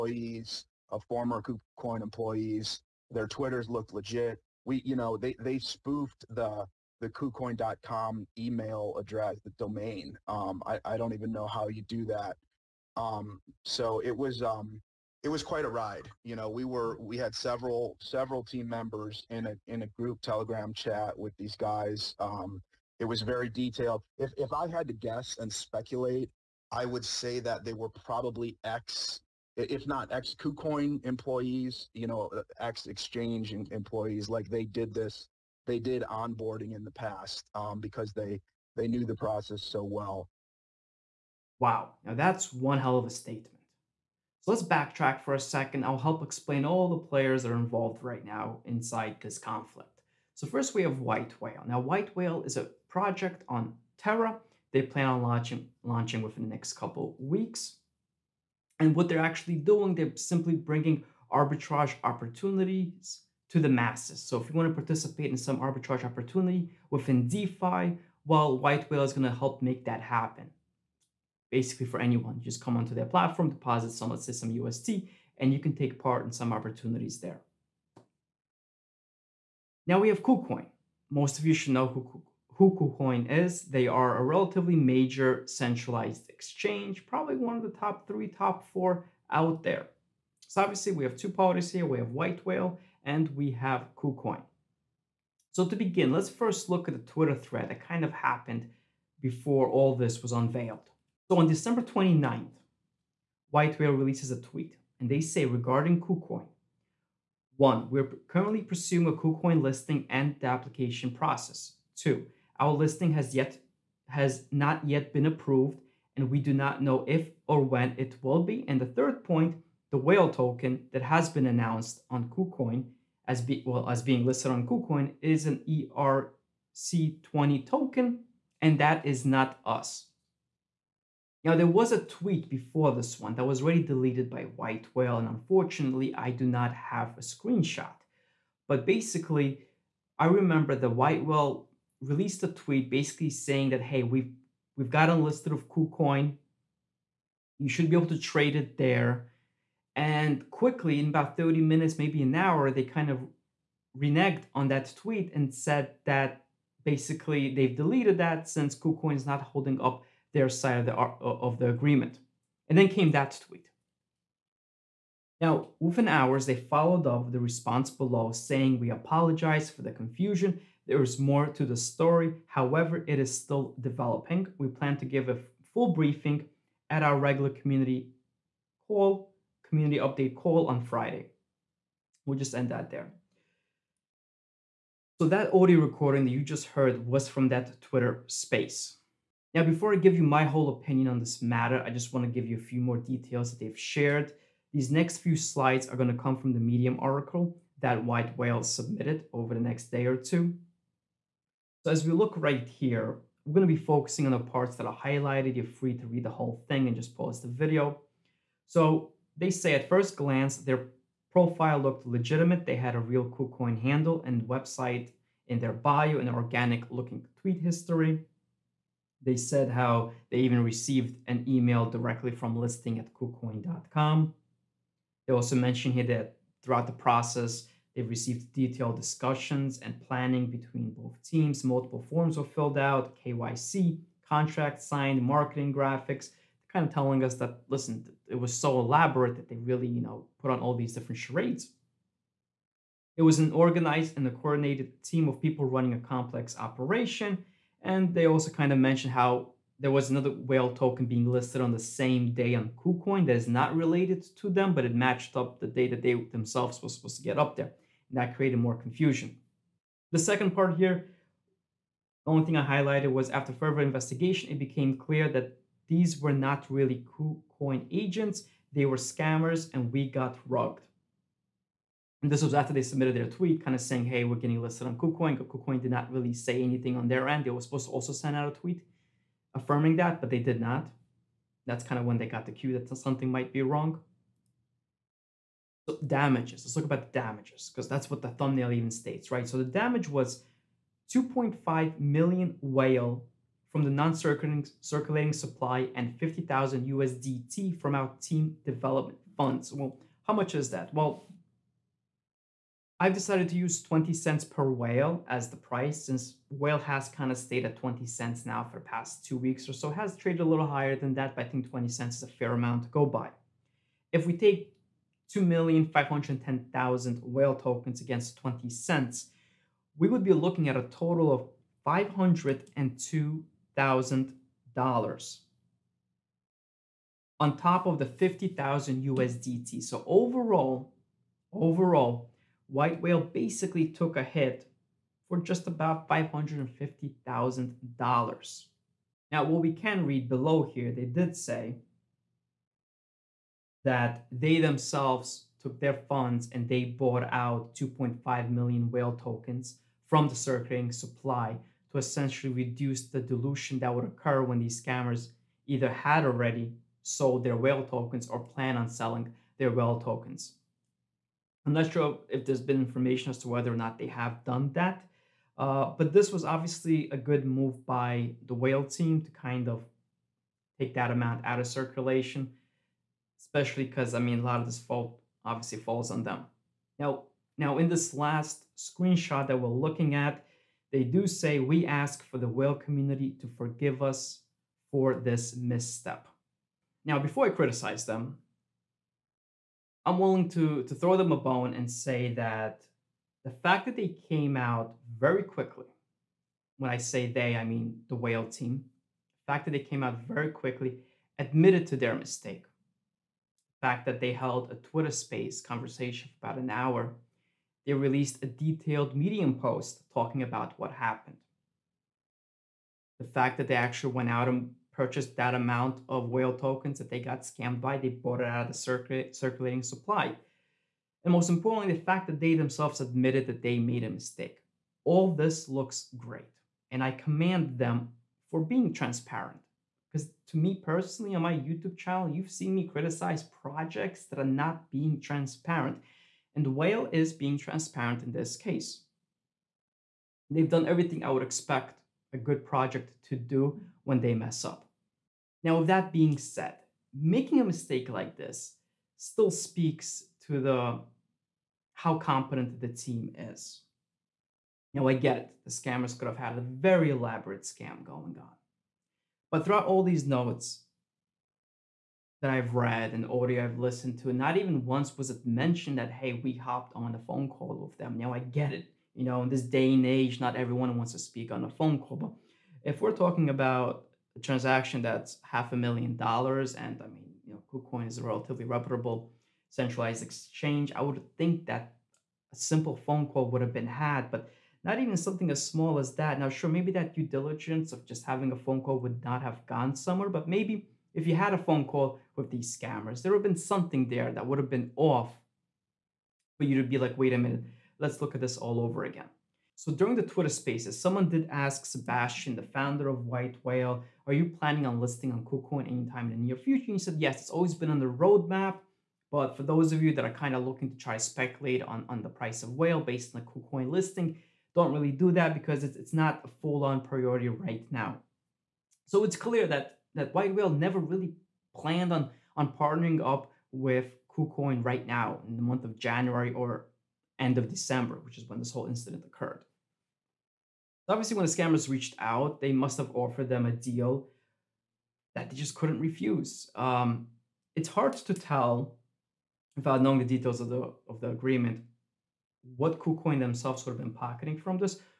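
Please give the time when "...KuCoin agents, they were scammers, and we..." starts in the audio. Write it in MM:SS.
04:27.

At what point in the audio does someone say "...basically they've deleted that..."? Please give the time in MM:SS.
02:36.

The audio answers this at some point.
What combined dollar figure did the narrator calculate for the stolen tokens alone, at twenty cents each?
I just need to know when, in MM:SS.
05:21.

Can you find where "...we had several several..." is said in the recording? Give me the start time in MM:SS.
00:16.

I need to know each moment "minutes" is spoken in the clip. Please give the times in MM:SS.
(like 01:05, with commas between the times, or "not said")
02:31, 08:17.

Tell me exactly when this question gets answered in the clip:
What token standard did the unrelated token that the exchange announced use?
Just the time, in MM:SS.
02:05.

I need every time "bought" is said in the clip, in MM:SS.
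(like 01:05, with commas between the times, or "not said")
05:46, 06:58.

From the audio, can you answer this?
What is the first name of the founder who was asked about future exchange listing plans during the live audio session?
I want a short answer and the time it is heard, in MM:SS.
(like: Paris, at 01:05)
Sebastian, at 08:21.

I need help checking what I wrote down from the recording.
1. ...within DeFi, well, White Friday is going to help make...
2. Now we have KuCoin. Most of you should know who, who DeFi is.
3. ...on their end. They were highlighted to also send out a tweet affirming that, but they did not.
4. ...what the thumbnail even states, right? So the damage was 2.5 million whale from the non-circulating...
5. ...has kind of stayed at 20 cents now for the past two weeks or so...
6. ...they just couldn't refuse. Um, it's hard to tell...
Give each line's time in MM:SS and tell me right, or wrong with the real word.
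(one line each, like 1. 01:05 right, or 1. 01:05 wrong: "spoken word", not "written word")
1. 01:06 wrong: "Whale", not "Friday"
2. 01:19 wrong: "KuCoin", not "DeFi"
3. 04:36 wrong: "supposed", not "highlighted"
4. 04:48 right
5. 05:06 right
6. 08:55 right.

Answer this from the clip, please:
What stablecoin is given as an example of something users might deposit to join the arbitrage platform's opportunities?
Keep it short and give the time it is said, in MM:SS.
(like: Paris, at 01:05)
UST, at 01:14.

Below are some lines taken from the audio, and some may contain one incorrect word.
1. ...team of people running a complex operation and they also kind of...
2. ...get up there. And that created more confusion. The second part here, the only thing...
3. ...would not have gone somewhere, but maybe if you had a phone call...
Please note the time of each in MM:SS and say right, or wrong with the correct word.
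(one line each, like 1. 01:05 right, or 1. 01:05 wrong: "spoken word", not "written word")
1. 04:05 right
2. 04:17 right
3. 08:08 right.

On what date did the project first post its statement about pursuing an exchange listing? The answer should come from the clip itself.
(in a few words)
December 29th.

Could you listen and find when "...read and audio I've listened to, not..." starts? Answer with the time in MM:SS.
07:42.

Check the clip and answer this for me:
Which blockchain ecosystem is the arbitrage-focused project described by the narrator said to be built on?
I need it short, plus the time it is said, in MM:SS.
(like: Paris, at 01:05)
Terra, at 00:53.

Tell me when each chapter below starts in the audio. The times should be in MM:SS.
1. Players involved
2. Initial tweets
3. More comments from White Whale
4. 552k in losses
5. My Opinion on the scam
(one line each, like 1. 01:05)
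1. 00:40
2. 01:40
3. 03:22
4. 05:02
5. 06:25.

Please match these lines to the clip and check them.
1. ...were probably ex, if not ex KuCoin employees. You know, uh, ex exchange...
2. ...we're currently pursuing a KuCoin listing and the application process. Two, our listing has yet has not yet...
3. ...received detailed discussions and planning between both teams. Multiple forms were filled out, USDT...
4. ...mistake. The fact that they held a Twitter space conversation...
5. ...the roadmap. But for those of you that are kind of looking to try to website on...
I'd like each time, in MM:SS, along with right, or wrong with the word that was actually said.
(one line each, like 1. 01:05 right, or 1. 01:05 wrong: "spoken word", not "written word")
1. 00:27 right
2. 01:47 right
3. 03:48 wrong: "KYC", not "USDT"
4. 06:42 right
5. 08:27 wrong: "speculate", not "website".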